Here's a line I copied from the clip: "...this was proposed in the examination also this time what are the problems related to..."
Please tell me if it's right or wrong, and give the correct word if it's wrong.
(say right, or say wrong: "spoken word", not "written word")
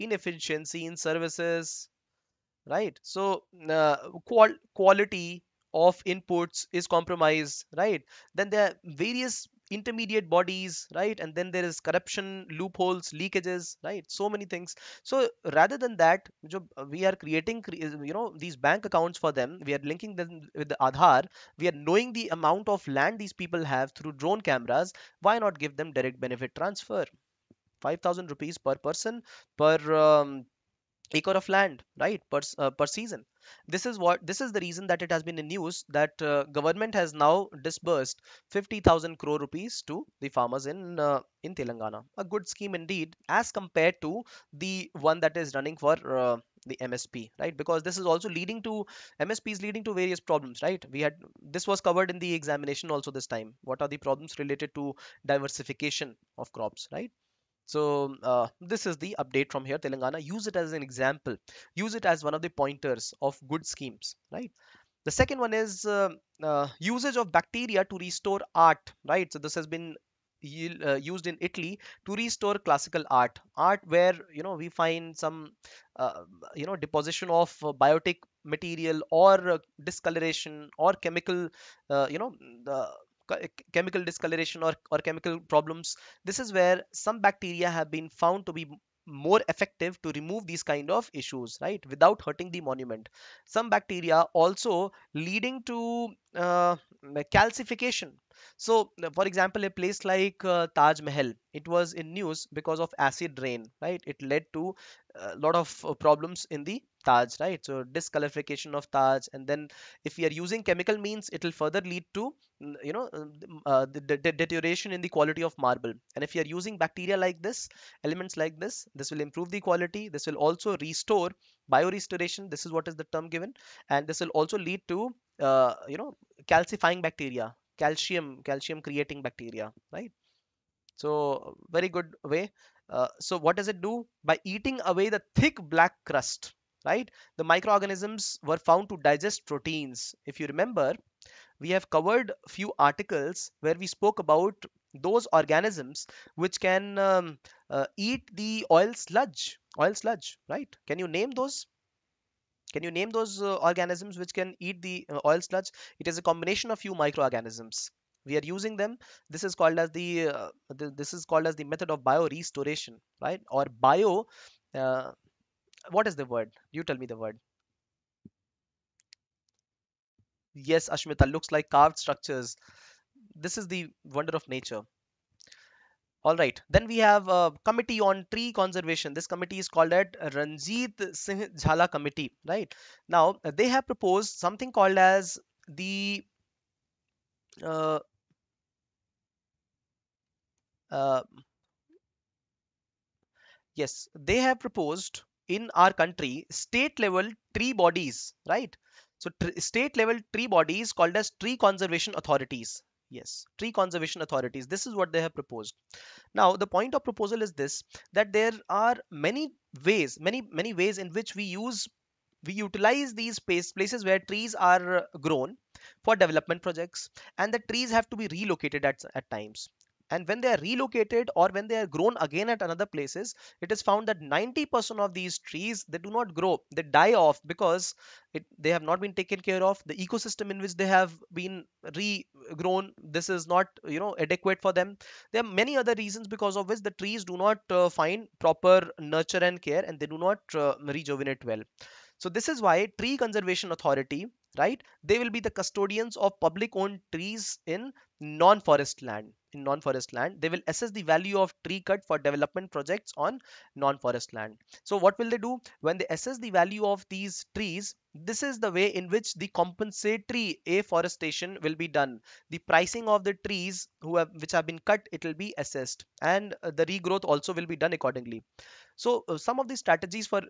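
wrong: "covered", not "proposed".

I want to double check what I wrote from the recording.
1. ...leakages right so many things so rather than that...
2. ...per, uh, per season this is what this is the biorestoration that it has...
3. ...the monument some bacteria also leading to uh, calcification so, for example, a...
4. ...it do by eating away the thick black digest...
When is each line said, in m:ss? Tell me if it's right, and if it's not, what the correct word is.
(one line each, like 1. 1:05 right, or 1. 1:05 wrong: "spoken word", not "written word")
1. 0:13 right
2. 0:32 wrong: "reason", not "biorestoration"
3. 1:32 right
4. 2:13 wrong: "crust", not "digest".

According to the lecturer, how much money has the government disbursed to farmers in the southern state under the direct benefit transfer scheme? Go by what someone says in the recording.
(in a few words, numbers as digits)
50000 crore rupees.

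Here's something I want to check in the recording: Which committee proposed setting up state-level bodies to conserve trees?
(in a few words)
Ranjit Singh Jhala committee.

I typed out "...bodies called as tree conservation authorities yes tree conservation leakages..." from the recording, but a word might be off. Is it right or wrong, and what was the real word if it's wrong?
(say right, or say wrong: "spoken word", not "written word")
wrong: "authorities", not "leakages".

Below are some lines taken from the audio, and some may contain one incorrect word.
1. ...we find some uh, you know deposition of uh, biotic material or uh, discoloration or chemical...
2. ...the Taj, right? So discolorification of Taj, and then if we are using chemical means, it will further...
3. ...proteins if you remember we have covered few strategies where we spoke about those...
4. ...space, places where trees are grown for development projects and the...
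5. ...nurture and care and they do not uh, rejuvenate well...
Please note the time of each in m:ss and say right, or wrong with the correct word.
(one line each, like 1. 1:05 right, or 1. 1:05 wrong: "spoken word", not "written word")
1. 1:14 right
2. 1:46 right
3. 2:19 wrong: "articles", not "strategies"
4. 3:33 right
5. 3:58 right.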